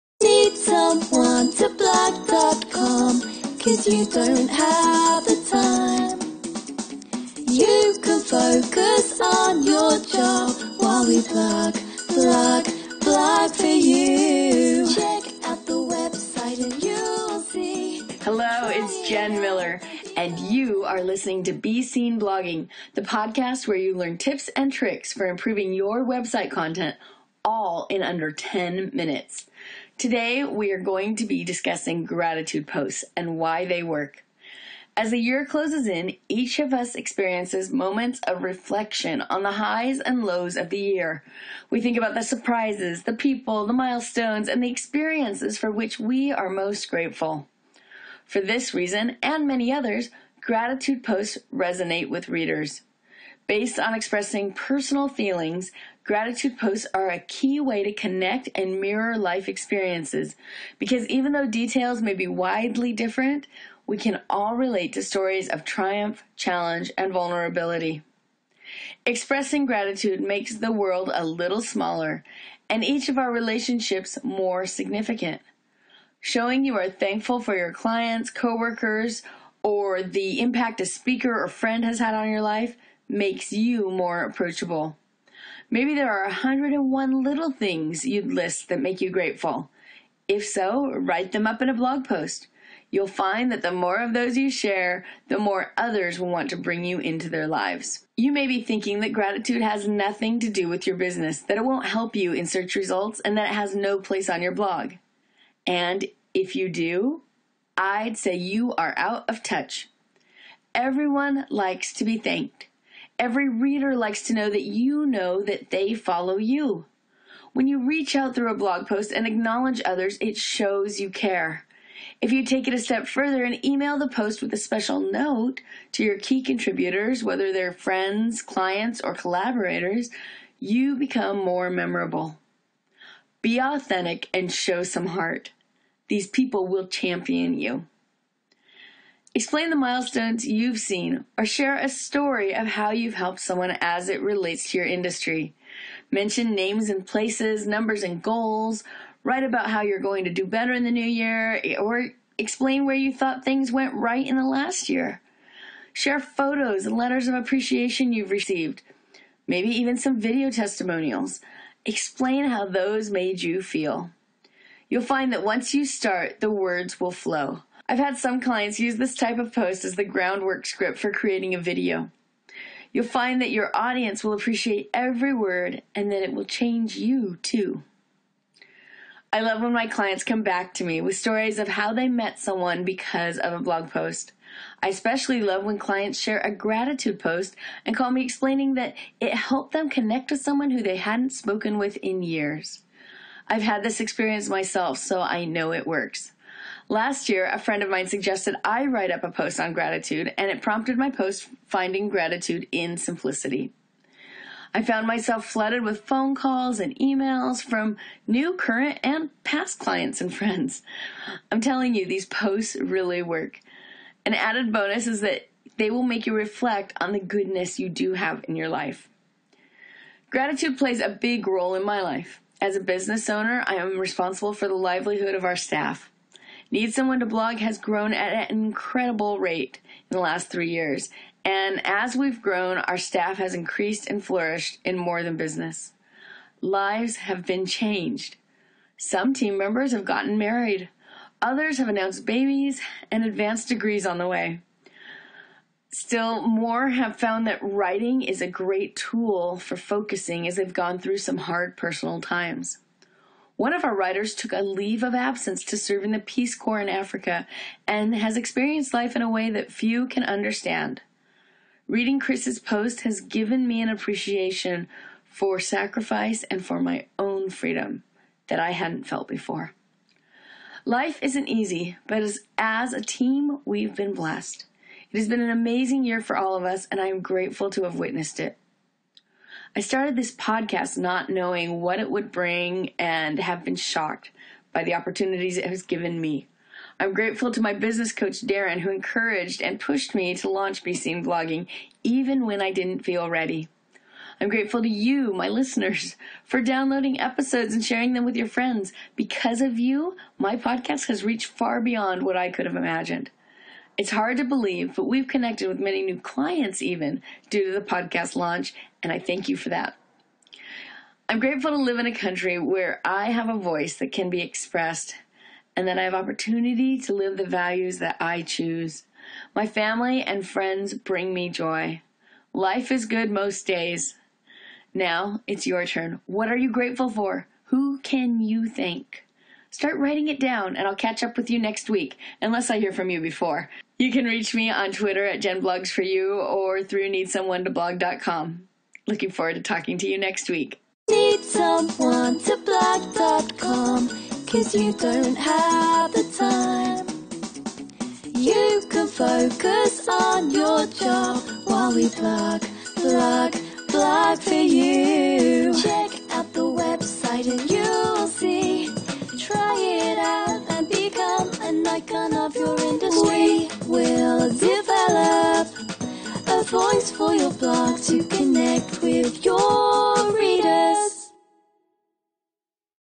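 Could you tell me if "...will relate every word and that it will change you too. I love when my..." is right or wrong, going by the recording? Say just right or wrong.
wrong.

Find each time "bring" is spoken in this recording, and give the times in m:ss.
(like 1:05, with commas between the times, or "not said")
1:36, 4:42, 5:20.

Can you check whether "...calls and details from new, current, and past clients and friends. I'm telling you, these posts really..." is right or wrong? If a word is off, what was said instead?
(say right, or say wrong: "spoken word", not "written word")
wrong: "emails", not "details".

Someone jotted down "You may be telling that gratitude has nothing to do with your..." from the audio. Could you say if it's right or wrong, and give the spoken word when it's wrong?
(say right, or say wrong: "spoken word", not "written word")
wrong: "thinking", not "telling".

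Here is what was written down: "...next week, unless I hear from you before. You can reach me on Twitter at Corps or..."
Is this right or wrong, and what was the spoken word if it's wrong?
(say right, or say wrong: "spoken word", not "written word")
wrong: "JenBlogsForYou", not "Corps".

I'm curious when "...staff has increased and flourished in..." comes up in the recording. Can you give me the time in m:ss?
3:52.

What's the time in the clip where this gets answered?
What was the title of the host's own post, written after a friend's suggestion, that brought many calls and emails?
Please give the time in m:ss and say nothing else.
3:21.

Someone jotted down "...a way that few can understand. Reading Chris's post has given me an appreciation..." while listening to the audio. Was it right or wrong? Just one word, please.
right.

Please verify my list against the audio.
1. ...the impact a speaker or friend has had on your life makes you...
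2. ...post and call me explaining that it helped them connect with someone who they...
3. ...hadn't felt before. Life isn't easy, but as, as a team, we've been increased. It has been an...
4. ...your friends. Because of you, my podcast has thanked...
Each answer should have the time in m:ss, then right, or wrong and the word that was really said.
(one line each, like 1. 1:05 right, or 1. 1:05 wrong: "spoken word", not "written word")
1. 1:20 right
2. 3:07 right
3. 4:28 wrong: "blessed", not "increased"
4. 4:58 wrong: "reached", not "thanked".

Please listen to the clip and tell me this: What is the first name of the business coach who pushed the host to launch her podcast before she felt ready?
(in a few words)
Darren.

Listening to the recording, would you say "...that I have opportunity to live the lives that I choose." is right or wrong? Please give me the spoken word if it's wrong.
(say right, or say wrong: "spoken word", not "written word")
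wrong: "values", not "lives".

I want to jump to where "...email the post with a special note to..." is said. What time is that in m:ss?
2:03.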